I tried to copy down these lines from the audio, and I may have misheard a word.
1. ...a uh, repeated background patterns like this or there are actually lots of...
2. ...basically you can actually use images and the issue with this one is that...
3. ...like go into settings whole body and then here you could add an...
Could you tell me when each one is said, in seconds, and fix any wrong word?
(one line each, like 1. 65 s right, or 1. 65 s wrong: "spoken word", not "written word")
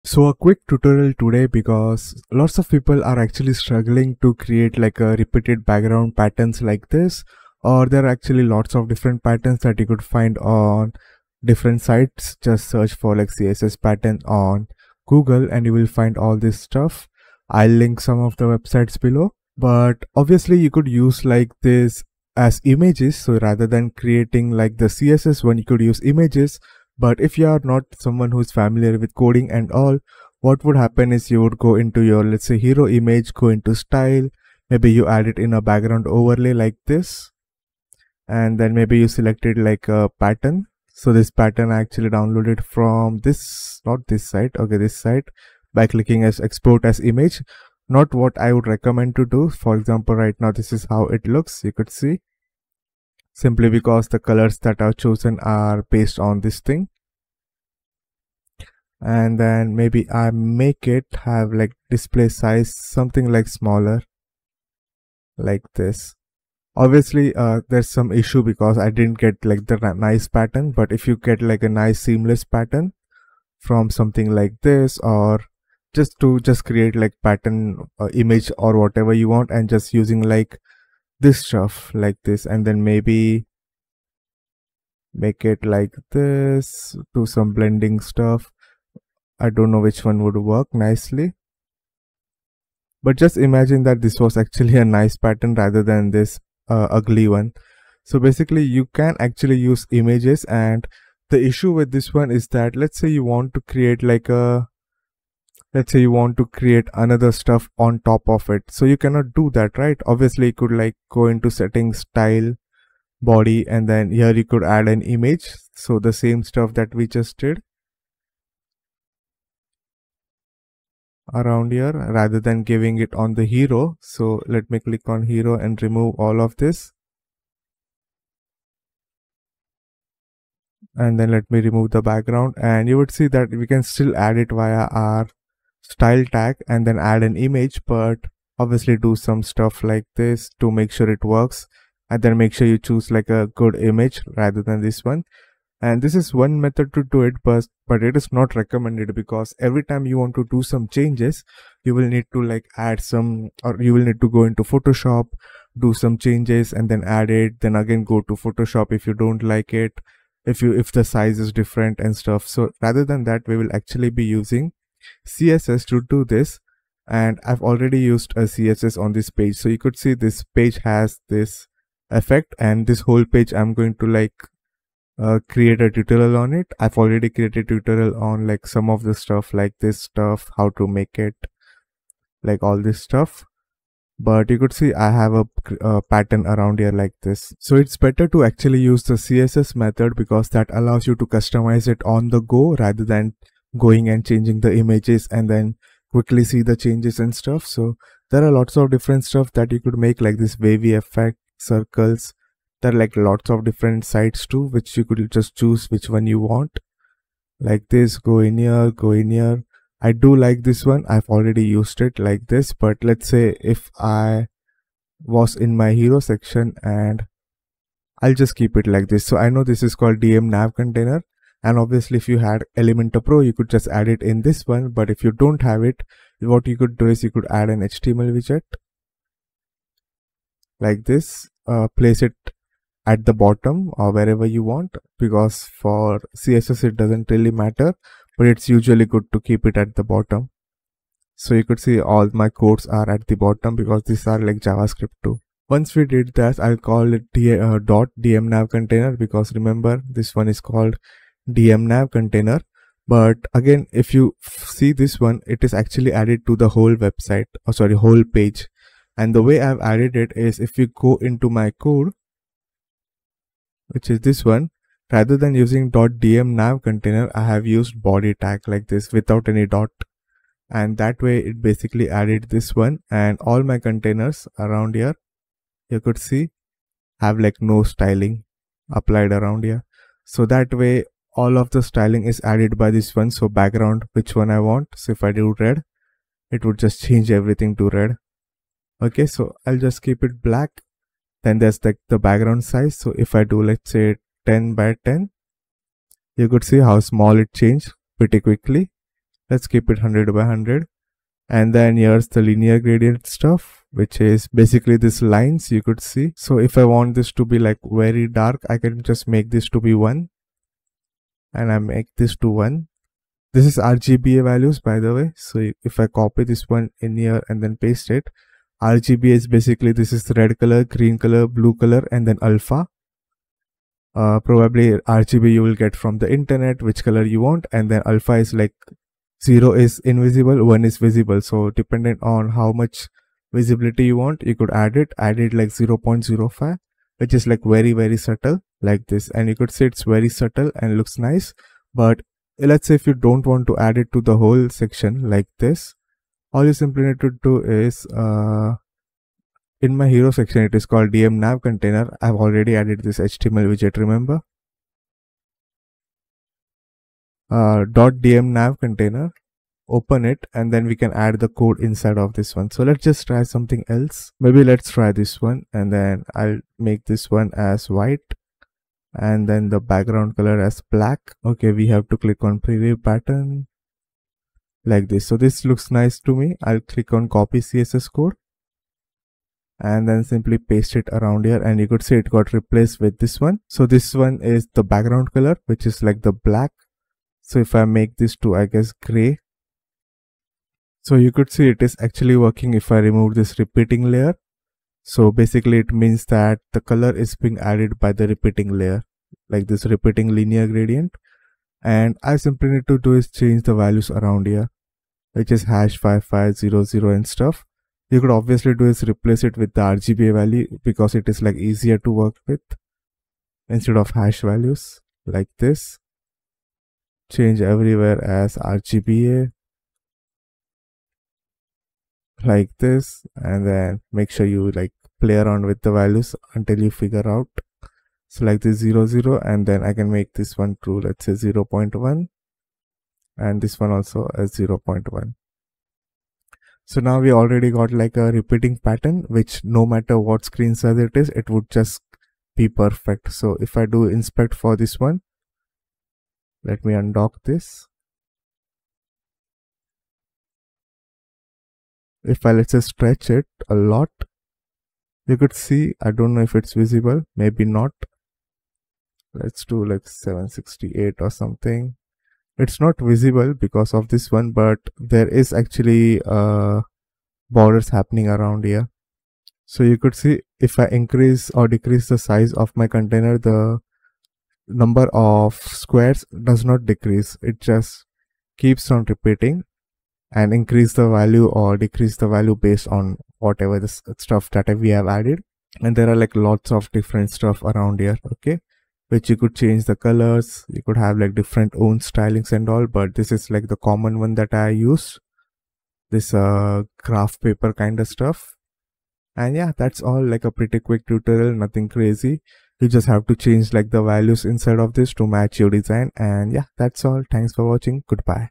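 1. 4 s right
2. 98 s right
3. 110 s wrong: "style", not "whole".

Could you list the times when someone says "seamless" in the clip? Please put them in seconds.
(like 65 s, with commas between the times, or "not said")
72 s.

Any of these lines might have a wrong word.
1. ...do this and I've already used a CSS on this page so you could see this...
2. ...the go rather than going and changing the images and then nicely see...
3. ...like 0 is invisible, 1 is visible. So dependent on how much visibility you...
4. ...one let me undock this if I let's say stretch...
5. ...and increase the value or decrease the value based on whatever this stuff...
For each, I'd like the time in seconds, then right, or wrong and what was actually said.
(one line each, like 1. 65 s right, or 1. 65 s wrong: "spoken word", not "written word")
1. 166 s right
2. 192 s wrong: "quickly", not "nicely"
3. 328 s right
4. 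444 s right
5. 480 s right.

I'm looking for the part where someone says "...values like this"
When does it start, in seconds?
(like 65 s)
414 s.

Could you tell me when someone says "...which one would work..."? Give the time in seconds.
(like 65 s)
89 s.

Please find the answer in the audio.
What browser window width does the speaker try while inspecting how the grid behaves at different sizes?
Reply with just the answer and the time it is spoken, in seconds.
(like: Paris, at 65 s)
768, at 460 s.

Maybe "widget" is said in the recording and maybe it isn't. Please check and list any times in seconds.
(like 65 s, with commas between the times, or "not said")
228 s, 353 s.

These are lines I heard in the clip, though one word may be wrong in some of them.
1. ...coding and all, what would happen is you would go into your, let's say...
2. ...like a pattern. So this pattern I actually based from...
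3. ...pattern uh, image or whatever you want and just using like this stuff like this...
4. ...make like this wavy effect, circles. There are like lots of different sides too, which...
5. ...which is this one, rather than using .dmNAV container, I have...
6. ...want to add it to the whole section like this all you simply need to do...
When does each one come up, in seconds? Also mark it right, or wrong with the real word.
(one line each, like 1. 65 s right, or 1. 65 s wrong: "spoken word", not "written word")
1. 29 s right
2. 39 s wrong: "downloaded", not "based"
3. 77 s right
4. 199 s right
5. 263 s right
6. 343 s right.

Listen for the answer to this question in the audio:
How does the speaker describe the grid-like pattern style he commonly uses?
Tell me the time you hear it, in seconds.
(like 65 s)
496 s.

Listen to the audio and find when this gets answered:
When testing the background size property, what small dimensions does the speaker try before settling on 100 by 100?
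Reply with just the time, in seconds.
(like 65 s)
294 s.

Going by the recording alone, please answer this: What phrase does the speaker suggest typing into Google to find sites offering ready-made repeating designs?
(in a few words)
css pattern.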